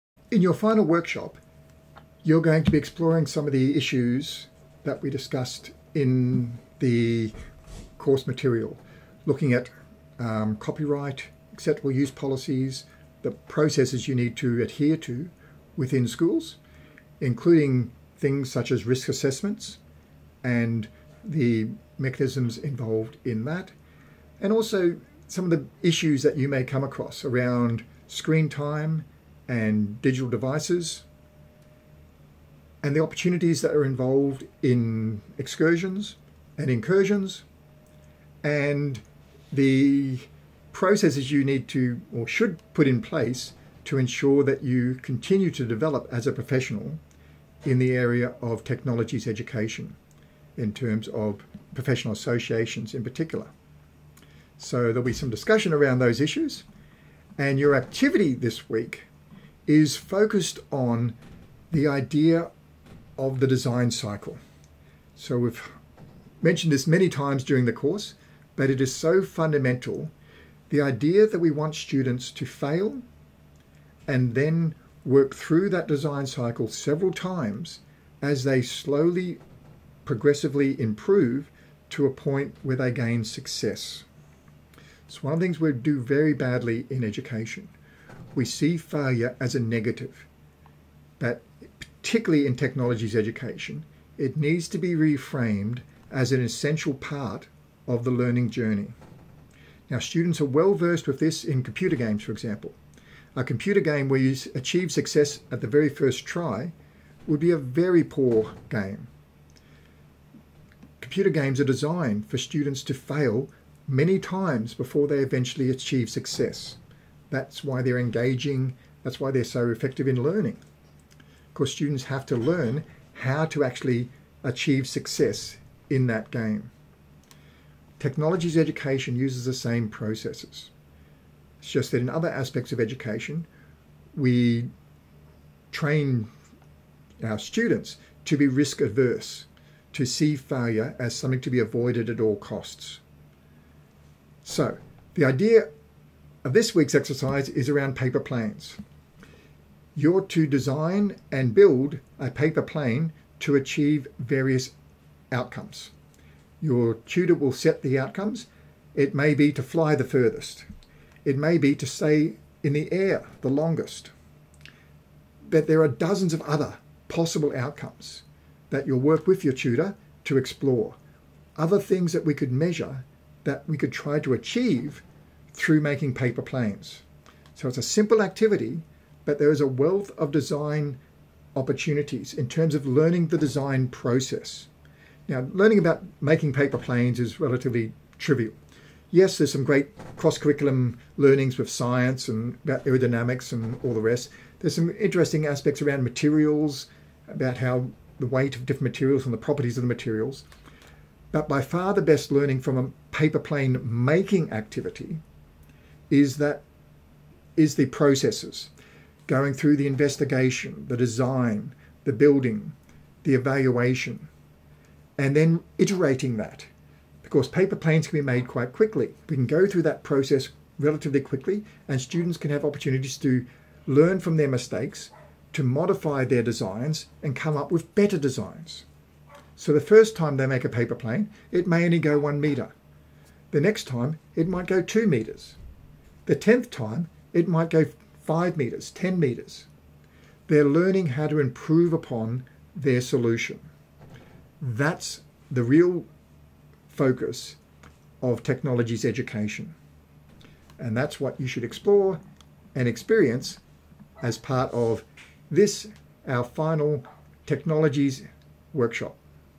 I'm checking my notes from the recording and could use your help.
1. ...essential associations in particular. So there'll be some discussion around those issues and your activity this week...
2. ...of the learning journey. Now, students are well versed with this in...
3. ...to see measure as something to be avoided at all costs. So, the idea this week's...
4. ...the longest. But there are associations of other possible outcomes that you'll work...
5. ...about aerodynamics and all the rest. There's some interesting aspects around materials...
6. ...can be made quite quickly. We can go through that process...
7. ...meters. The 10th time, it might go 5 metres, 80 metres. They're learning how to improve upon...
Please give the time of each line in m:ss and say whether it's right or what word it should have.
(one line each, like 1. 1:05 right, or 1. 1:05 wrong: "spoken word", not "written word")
1. 0:51 wrong: "professional", not "essential"
2. 1:37 right
3. 2:19 wrong: "failure", not "measure"
4. 2:43 wrong: "dozens", not "associations"
5. 3:12 right
6. 3:38 right
7. 3:55 wrong: "10", not "80".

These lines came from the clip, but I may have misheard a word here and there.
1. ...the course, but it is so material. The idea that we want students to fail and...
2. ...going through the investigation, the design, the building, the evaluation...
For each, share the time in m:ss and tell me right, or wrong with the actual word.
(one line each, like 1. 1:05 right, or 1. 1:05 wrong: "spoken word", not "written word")
1. 1:07 wrong: "fundamental", not "material"
2. 3:29 right.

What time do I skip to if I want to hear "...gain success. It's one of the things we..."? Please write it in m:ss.
1:22.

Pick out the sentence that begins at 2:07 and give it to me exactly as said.
Technologies education uses the same processes.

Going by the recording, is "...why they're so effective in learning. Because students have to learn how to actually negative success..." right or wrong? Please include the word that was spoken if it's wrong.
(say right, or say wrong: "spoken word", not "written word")
wrong: "achieve", not "negative".